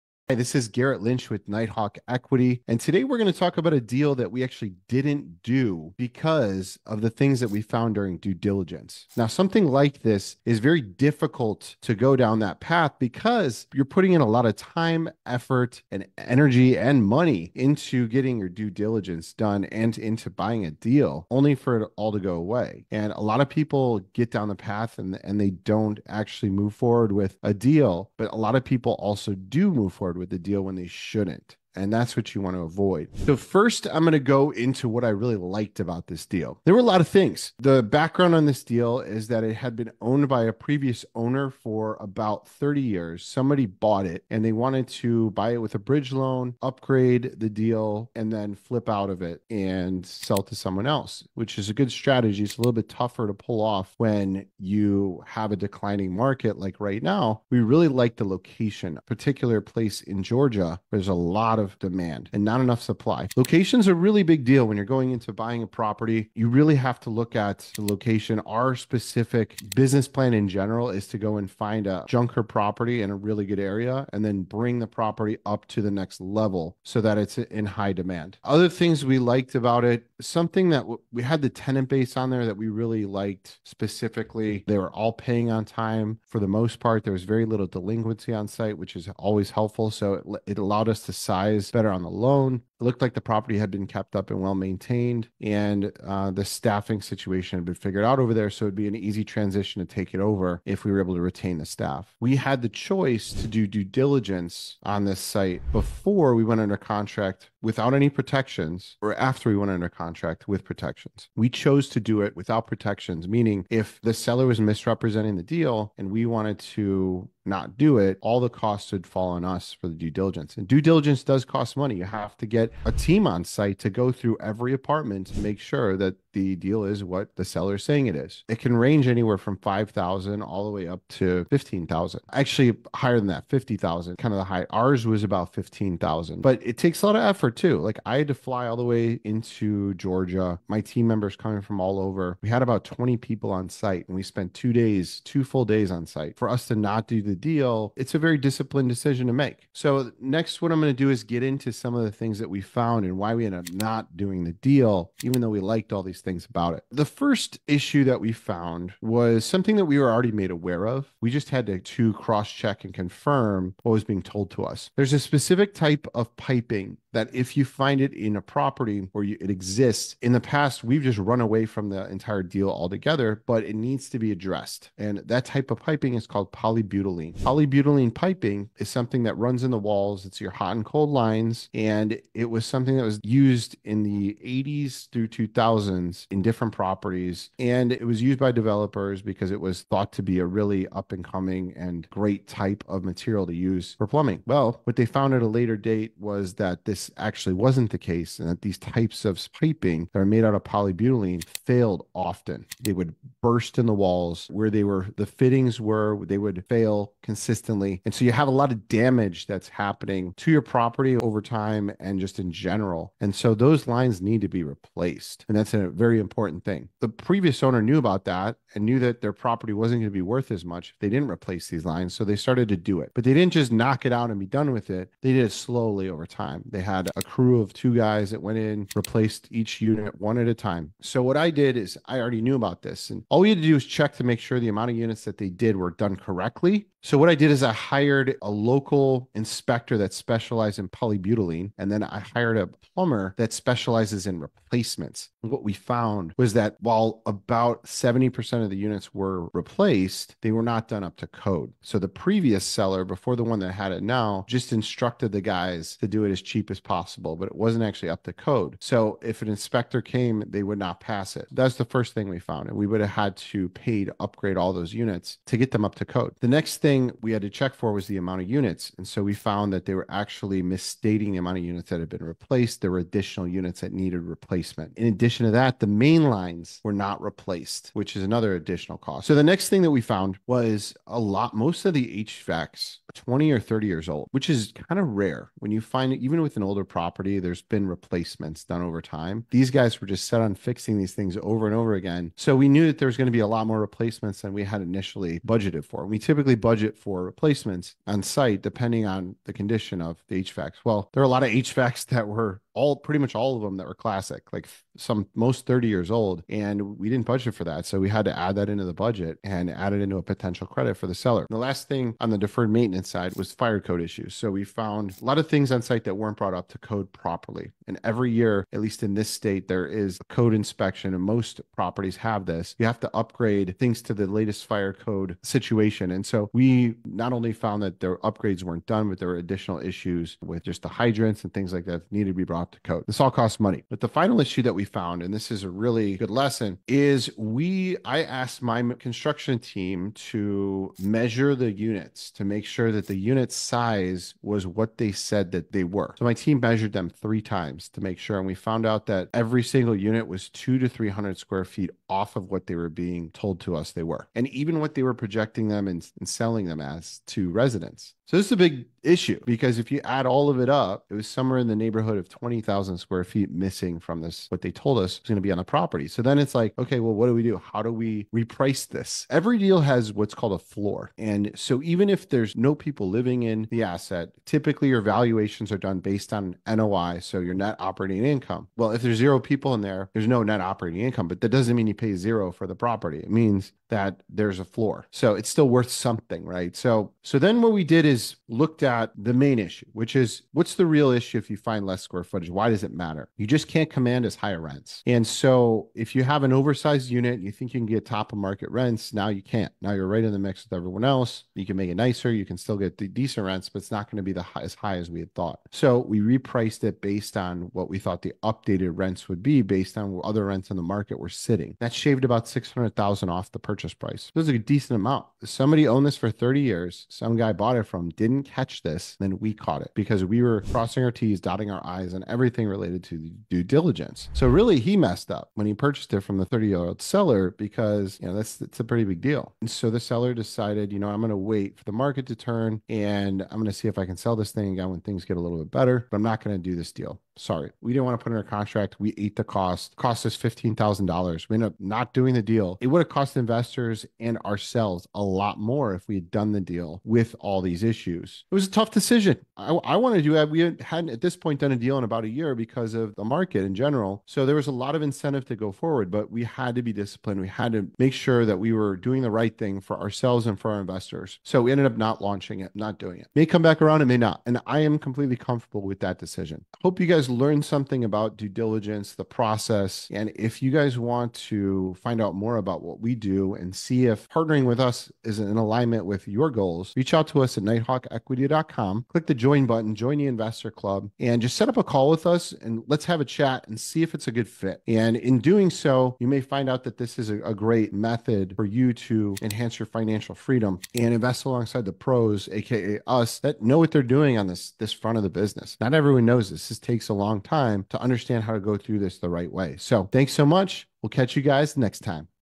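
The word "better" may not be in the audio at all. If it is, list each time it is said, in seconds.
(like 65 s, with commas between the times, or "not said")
91 s, 435 s.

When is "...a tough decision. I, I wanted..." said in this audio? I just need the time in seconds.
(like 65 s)
448 s.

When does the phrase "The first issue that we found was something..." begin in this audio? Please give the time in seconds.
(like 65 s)
156 s.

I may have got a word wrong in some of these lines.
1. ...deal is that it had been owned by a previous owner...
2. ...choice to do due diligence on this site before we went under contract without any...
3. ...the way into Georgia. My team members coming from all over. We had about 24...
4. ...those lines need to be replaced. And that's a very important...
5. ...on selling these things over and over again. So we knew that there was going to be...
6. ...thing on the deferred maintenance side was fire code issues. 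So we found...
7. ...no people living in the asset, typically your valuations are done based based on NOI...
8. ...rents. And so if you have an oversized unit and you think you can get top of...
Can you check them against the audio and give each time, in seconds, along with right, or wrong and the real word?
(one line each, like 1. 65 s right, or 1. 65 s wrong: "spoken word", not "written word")
1. 38 s right
2. 102 s right
3. 138 s wrong: "20", not "24"
4. 213 s right
5. 290 s wrong: "fixing", not "selling"
6. 311 s right
7. 372 s right
8. 394 s right.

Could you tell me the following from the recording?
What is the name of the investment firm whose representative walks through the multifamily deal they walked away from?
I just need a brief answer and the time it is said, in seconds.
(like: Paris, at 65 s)
Nighthawk Equity, at 1 s.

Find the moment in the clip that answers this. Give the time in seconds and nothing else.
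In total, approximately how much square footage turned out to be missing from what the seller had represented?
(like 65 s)
362 s.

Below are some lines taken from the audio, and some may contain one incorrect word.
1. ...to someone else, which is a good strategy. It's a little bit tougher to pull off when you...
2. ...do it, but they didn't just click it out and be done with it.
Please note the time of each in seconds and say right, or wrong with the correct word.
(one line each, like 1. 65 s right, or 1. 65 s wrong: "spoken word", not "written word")
1. 50 s right
2. 222 s wrong: "knock", not "click".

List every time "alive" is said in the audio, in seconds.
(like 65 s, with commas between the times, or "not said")
not said.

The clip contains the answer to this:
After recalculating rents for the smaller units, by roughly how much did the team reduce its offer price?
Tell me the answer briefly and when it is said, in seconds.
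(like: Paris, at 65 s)
$600,000, at 412 s.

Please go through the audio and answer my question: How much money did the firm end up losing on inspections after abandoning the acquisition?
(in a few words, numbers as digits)
$15,000.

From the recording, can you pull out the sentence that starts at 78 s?
Other things we liked about it, something that we had the tenant base on there that we really liked specifically.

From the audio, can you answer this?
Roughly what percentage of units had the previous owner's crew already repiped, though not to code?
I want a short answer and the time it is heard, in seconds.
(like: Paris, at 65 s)
70%, at 247 s.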